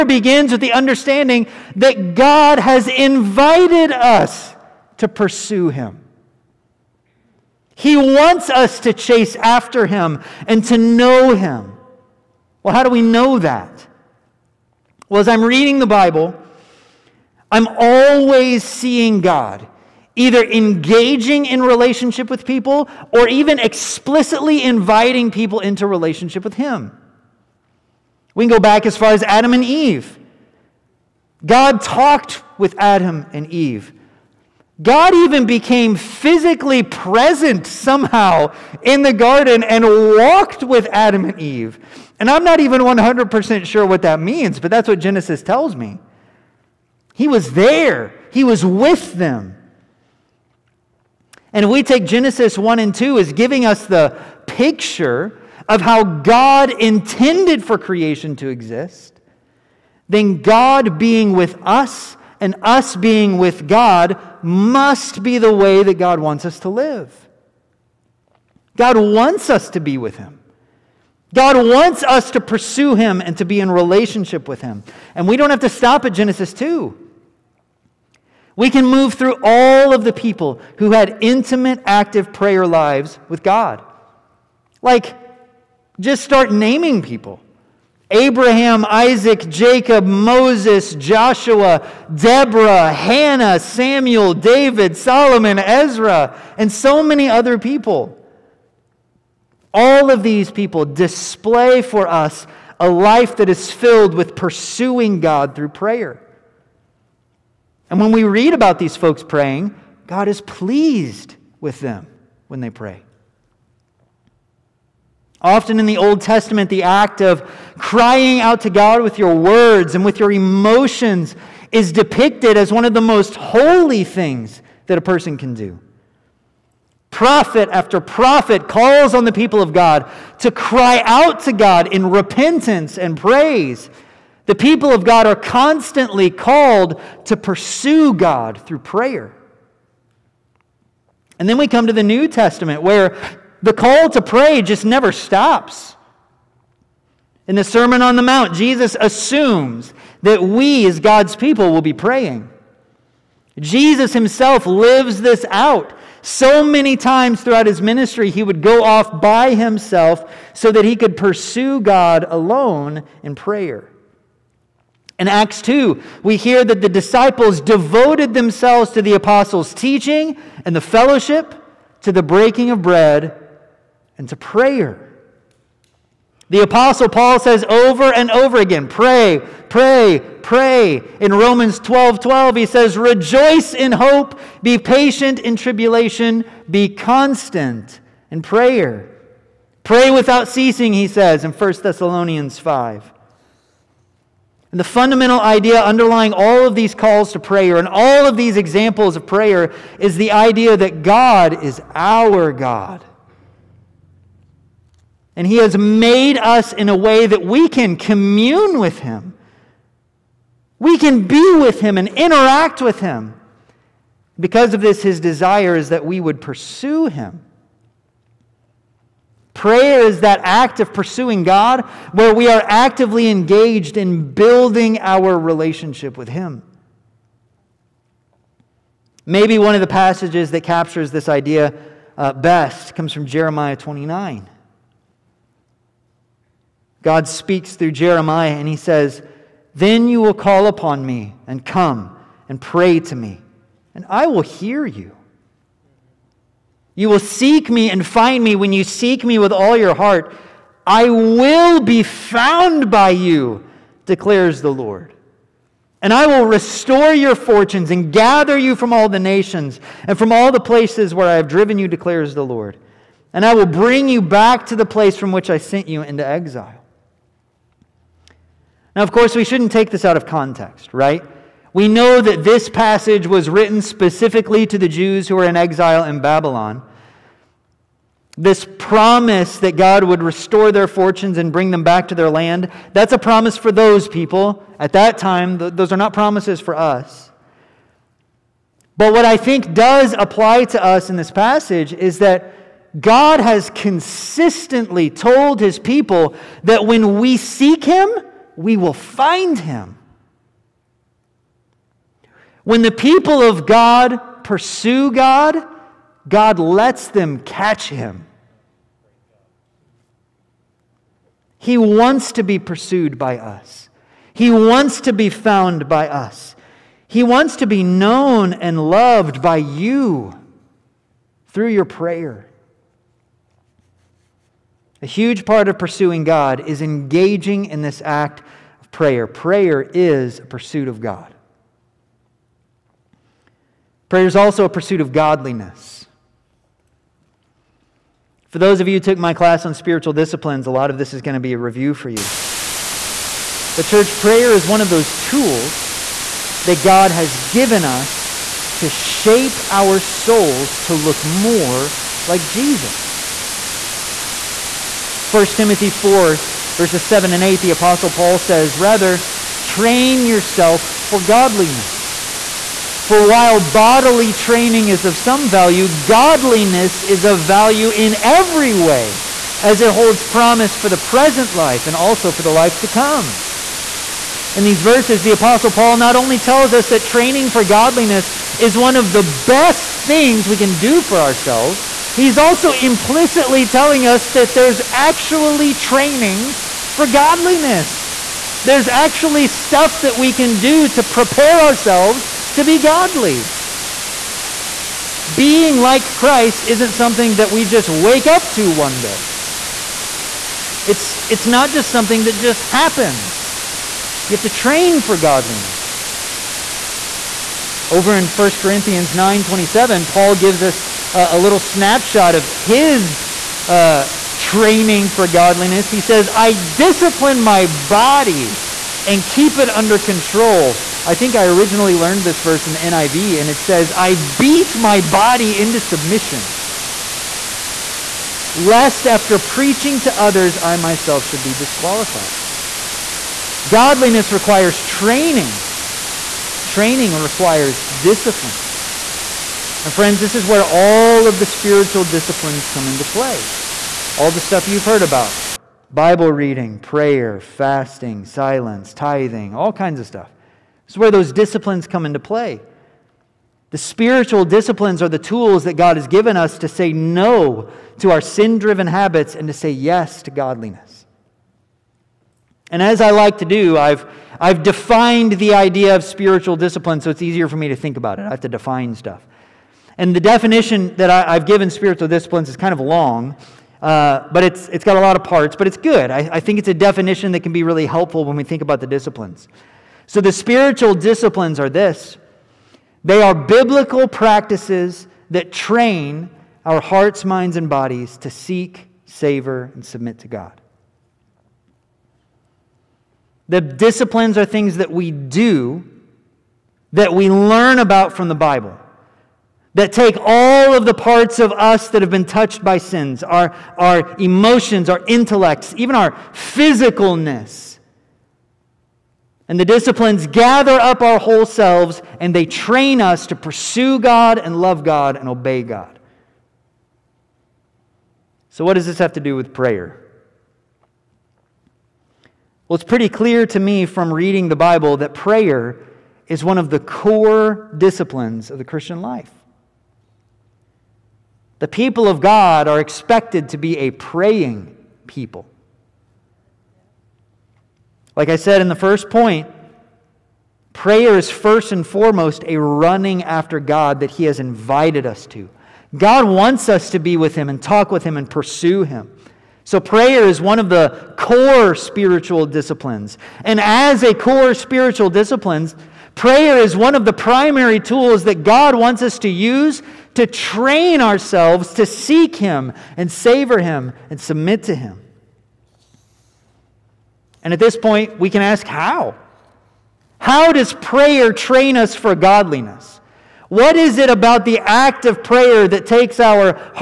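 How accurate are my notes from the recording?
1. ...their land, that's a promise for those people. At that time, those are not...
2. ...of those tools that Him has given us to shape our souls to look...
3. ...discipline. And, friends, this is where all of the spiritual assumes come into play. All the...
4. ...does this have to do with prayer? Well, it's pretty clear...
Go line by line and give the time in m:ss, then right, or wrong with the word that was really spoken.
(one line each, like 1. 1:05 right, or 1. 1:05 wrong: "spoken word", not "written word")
1. 4:42 right
2. 5:44 wrong: "God", not "Him"
3. 7:17 wrong: "disciplines", not "assumes"
4. 8:38 right.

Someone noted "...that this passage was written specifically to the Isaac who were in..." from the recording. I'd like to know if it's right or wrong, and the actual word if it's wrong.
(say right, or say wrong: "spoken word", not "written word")
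wrong: "Jews", not "Isaac".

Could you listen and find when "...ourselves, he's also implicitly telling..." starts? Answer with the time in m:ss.
6:21.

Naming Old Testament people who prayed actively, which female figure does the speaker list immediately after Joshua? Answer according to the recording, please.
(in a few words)
Deborah.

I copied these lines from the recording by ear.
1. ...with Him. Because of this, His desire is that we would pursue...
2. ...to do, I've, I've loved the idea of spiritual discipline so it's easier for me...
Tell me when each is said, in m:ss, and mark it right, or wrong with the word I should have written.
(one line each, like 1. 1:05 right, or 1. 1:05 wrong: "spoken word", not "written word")
1. 3:32 right
2. 7:43 wrong: "defined", not "loved".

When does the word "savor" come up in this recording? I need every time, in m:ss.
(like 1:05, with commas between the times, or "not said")
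8:09, 9:23.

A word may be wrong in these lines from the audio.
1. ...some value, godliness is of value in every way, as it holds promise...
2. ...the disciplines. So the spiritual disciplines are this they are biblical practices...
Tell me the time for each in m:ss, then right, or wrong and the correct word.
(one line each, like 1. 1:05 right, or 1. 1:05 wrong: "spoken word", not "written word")
1. 6:05 right
2. 7:58 right.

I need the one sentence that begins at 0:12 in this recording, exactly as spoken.
Well, how do we know that?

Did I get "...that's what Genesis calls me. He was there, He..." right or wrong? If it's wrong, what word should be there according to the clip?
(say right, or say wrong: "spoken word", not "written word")
wrong: "tells", not "calls".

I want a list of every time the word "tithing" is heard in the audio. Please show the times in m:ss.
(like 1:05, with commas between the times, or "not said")
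7:28.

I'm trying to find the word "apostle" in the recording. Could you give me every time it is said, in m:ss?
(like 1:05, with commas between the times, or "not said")
2:49, 2:56, 5:57, 6:15.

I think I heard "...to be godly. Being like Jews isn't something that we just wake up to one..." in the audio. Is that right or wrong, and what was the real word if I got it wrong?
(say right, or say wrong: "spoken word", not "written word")
wrong: "Christ", not "Jews".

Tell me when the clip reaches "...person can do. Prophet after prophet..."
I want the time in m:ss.
2:05.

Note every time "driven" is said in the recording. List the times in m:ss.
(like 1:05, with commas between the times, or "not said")
4:21, 7:38.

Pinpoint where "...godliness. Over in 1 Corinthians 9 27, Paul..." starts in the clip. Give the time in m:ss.
6:45.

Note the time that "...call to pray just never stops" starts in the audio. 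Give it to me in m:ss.
2:23.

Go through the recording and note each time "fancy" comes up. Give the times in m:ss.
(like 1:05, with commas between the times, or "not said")
not said.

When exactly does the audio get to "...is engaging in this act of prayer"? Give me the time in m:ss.
5:26.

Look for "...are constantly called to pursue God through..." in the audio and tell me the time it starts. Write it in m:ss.
2:15.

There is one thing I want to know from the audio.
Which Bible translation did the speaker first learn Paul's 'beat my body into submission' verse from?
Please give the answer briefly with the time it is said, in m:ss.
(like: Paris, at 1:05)
NIV, at 7:02.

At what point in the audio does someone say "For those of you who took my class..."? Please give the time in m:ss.
5:38.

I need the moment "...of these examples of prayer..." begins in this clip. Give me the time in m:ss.
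3:18.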